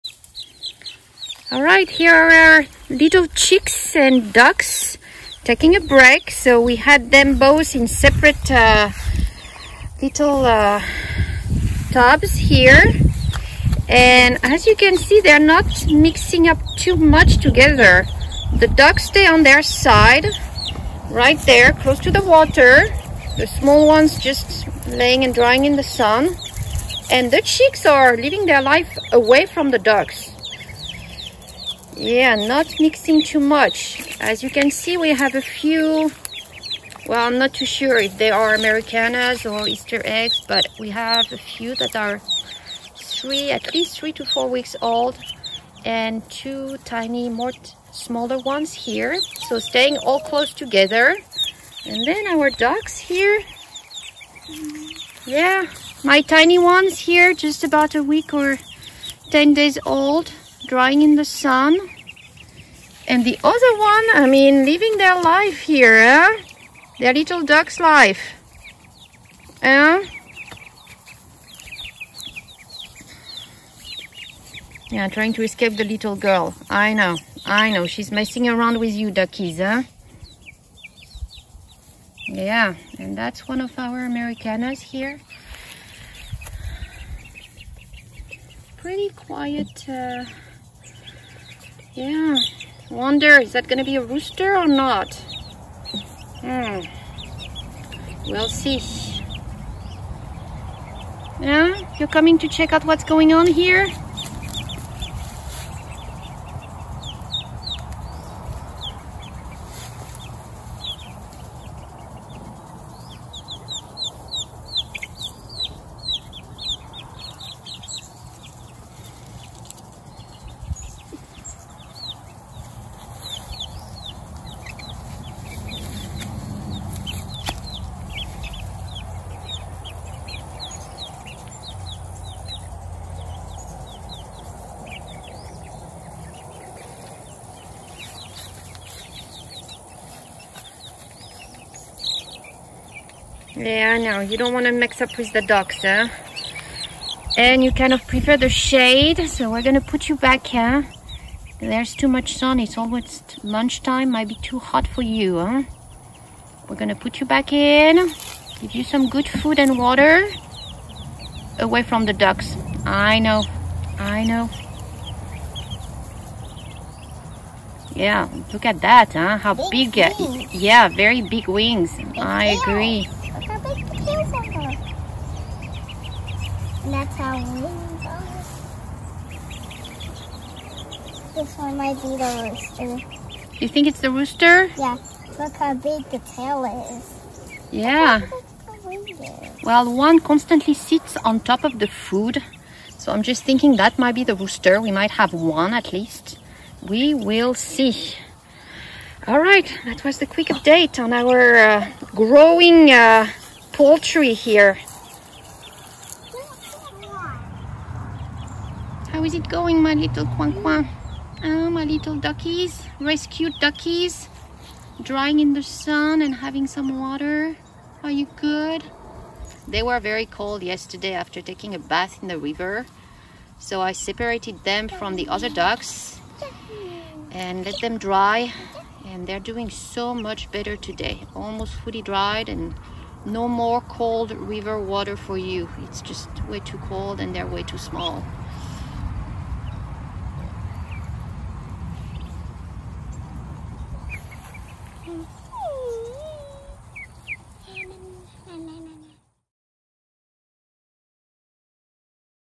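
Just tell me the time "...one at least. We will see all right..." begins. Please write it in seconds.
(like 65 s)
195 s.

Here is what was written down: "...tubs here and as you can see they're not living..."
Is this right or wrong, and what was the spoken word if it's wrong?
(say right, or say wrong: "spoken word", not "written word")
wrong: "mixing", not "living".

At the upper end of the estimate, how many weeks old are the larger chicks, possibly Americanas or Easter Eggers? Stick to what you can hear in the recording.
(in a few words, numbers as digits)
4 weeks.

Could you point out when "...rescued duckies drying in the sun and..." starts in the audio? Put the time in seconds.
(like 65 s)
212 s.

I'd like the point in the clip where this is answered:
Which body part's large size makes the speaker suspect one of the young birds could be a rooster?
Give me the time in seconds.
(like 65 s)
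186 s.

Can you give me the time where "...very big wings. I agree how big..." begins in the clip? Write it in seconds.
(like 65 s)
170 s.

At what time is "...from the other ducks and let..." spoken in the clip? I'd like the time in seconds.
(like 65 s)
224 s.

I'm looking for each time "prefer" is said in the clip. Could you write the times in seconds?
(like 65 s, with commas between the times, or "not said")
148 s.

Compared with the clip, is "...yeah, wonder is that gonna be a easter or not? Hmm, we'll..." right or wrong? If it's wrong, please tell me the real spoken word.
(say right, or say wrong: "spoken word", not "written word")
wrong: "rooster", not "easter".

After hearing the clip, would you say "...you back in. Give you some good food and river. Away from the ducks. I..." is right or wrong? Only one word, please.
wrong.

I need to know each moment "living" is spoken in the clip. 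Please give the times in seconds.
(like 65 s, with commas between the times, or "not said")
28 s, 64 s.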